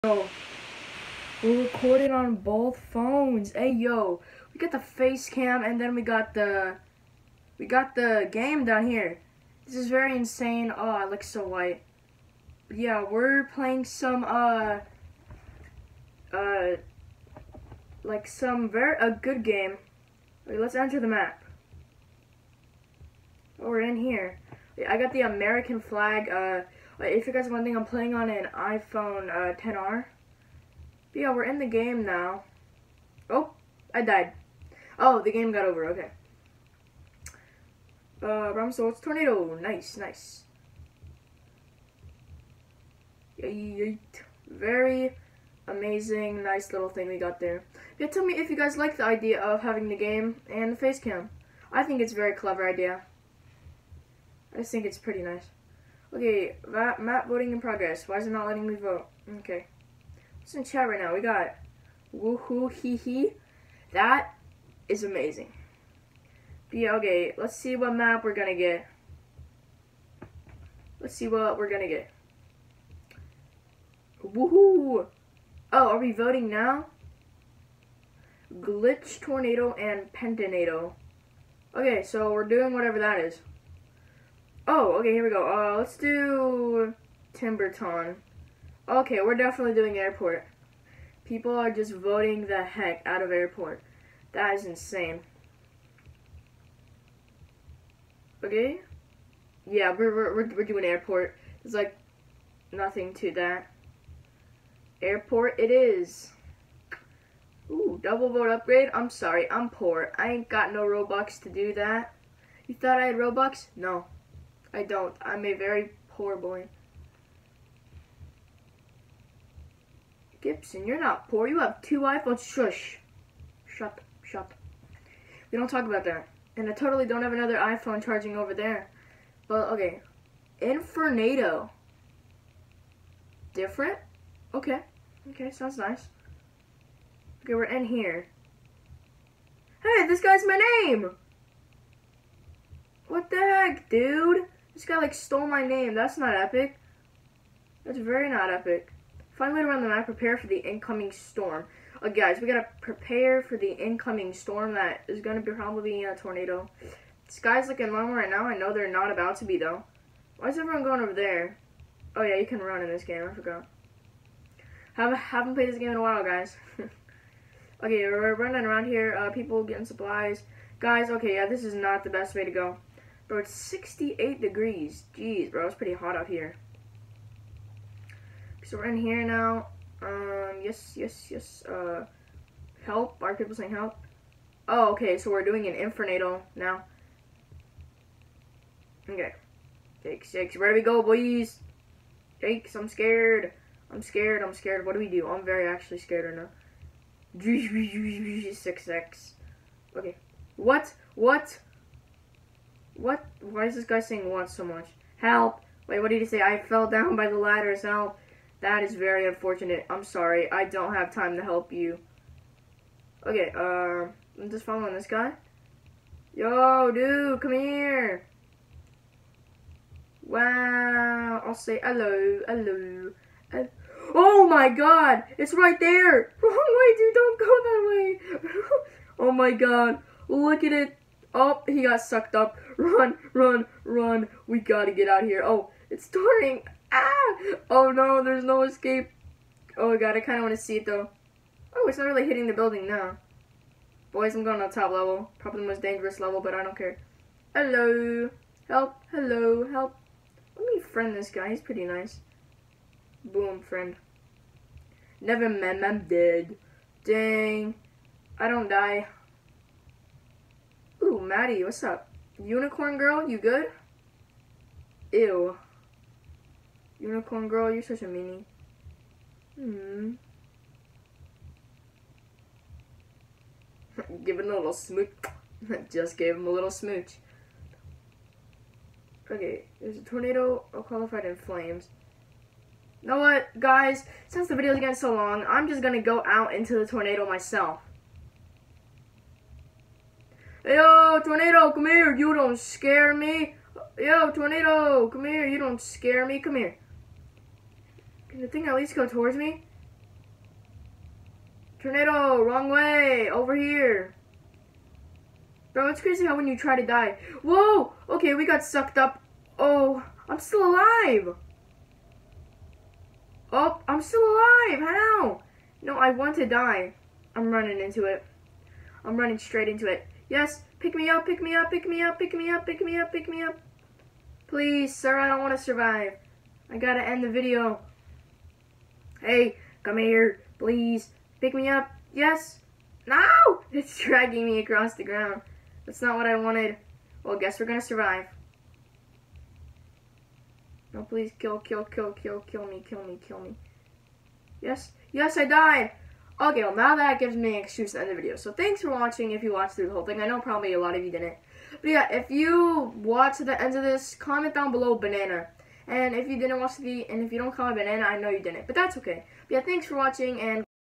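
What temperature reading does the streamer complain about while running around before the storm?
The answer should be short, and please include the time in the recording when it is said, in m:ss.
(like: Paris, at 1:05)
68 degrees, at 2:53.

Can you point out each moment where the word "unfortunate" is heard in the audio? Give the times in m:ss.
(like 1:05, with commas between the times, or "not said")
3:29.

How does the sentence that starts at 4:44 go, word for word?
Since the video's getting so long, I'm just gonna go out into the tornado myself.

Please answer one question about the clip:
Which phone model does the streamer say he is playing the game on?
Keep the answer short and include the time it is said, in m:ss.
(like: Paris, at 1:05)
iPhone 10R, at 0:28.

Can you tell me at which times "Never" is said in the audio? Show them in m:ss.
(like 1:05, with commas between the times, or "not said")
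4:15.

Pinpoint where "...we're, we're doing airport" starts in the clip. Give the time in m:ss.
1:40.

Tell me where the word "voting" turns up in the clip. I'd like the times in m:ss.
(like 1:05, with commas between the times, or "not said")
0:57, 1:16, 1:31.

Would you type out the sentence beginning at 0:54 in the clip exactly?
I just think it's pretty nice.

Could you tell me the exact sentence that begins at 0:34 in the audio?
Oh, the game got over, okay.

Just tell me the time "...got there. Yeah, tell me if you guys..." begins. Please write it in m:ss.
0:47.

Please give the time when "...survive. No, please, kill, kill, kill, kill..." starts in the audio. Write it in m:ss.
5:37.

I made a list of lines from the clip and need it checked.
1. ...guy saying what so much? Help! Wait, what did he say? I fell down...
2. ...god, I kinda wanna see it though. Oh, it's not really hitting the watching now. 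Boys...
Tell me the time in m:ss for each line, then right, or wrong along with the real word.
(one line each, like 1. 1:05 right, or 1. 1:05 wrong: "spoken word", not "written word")
1. 3:23 right
2. 3:59 wrong: "building", not "watching".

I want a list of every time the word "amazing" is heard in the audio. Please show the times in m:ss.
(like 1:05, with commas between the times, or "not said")
0:45, 1:05.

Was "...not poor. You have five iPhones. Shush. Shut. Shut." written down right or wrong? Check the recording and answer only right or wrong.
wrong.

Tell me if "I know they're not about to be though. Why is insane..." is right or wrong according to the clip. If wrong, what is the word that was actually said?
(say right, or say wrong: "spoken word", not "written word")
wrong: "everyone", not "insane".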